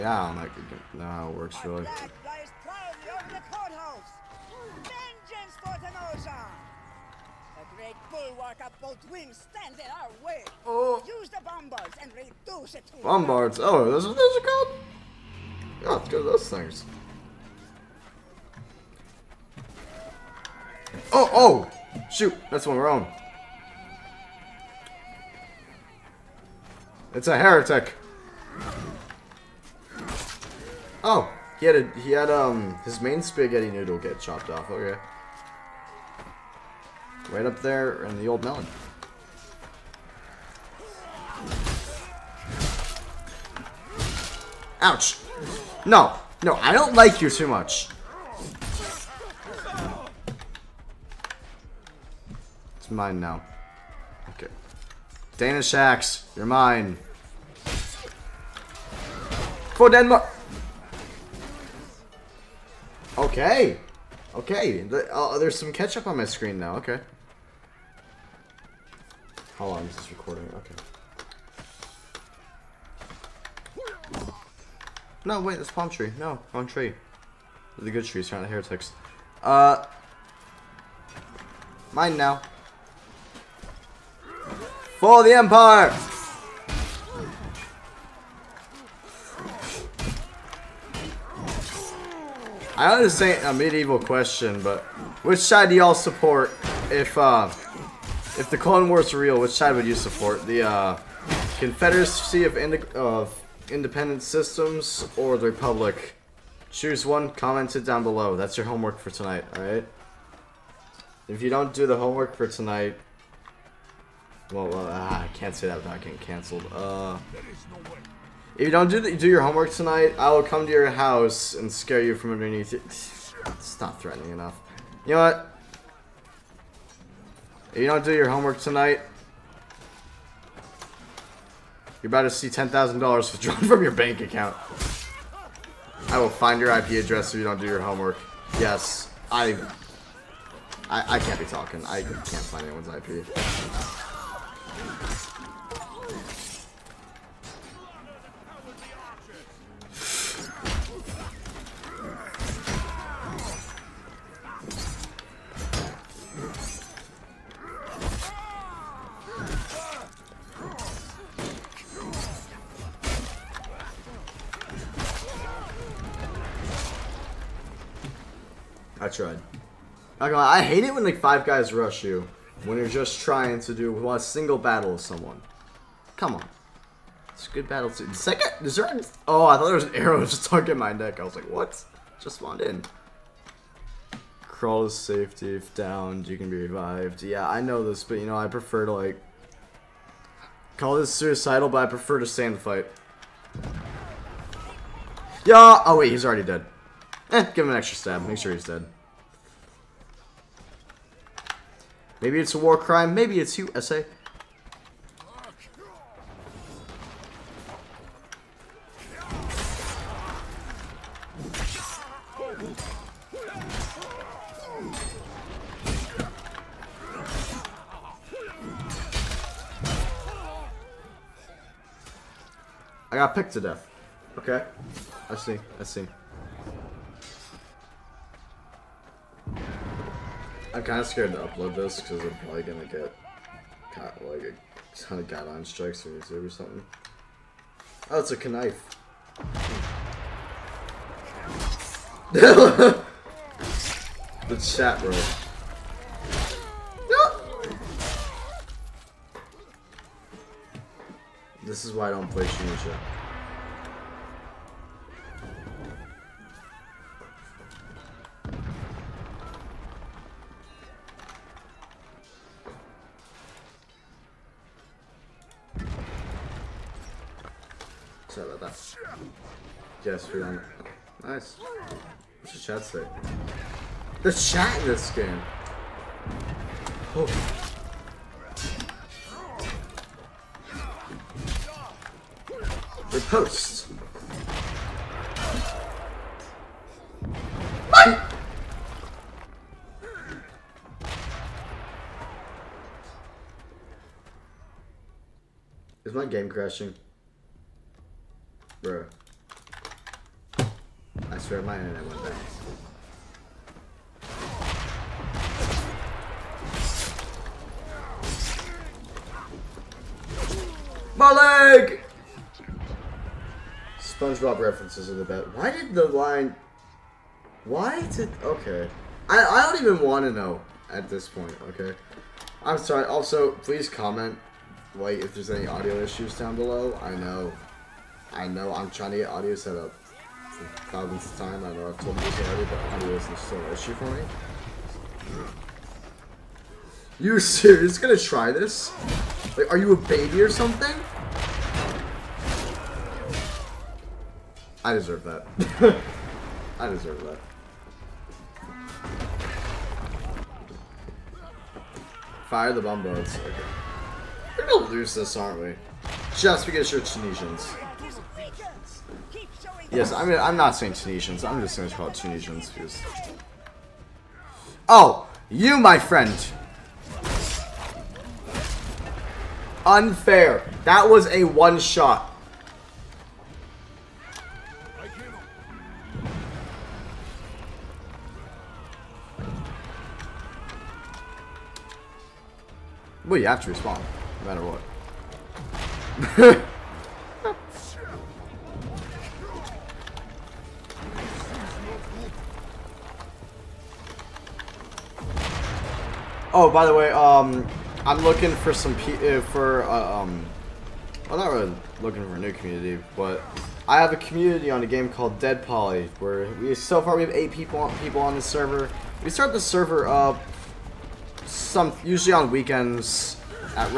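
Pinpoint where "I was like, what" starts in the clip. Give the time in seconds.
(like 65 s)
181 s.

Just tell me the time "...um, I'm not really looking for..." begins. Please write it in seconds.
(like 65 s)
400 s.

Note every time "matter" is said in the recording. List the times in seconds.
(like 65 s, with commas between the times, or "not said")
384 s.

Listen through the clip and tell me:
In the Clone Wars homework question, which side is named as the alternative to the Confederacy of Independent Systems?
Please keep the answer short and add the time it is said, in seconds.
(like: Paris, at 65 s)
The Republic, at 105 s.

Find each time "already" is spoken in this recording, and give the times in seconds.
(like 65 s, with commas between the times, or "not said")
196 s, 332 s.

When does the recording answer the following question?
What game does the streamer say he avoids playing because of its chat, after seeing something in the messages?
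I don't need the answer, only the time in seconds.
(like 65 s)
252 s.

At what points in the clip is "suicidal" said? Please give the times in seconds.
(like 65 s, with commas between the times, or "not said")
191 s.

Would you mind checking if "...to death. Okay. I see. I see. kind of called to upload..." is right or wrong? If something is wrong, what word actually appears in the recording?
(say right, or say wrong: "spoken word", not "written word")
wrong: "scared", not "called".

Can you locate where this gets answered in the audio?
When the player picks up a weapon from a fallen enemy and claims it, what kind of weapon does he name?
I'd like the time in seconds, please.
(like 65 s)
55 s.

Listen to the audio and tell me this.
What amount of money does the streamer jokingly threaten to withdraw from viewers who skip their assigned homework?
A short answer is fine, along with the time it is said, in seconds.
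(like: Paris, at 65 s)
$10,000, at 132 s.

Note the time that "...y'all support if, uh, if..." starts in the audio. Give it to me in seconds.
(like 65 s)
95 s.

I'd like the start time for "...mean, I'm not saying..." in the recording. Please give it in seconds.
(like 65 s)
360 s.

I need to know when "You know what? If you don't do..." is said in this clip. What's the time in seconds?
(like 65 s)
125 s.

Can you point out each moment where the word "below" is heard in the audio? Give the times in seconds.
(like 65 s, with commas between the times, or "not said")
108 s, 326 s.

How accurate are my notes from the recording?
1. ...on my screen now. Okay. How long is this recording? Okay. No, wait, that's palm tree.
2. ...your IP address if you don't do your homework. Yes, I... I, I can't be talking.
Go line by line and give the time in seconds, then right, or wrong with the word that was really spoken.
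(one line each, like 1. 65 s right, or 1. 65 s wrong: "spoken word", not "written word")
1. 66 s right
2. 136 s right.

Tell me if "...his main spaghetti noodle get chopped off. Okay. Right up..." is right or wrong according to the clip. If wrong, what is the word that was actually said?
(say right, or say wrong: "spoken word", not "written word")
right.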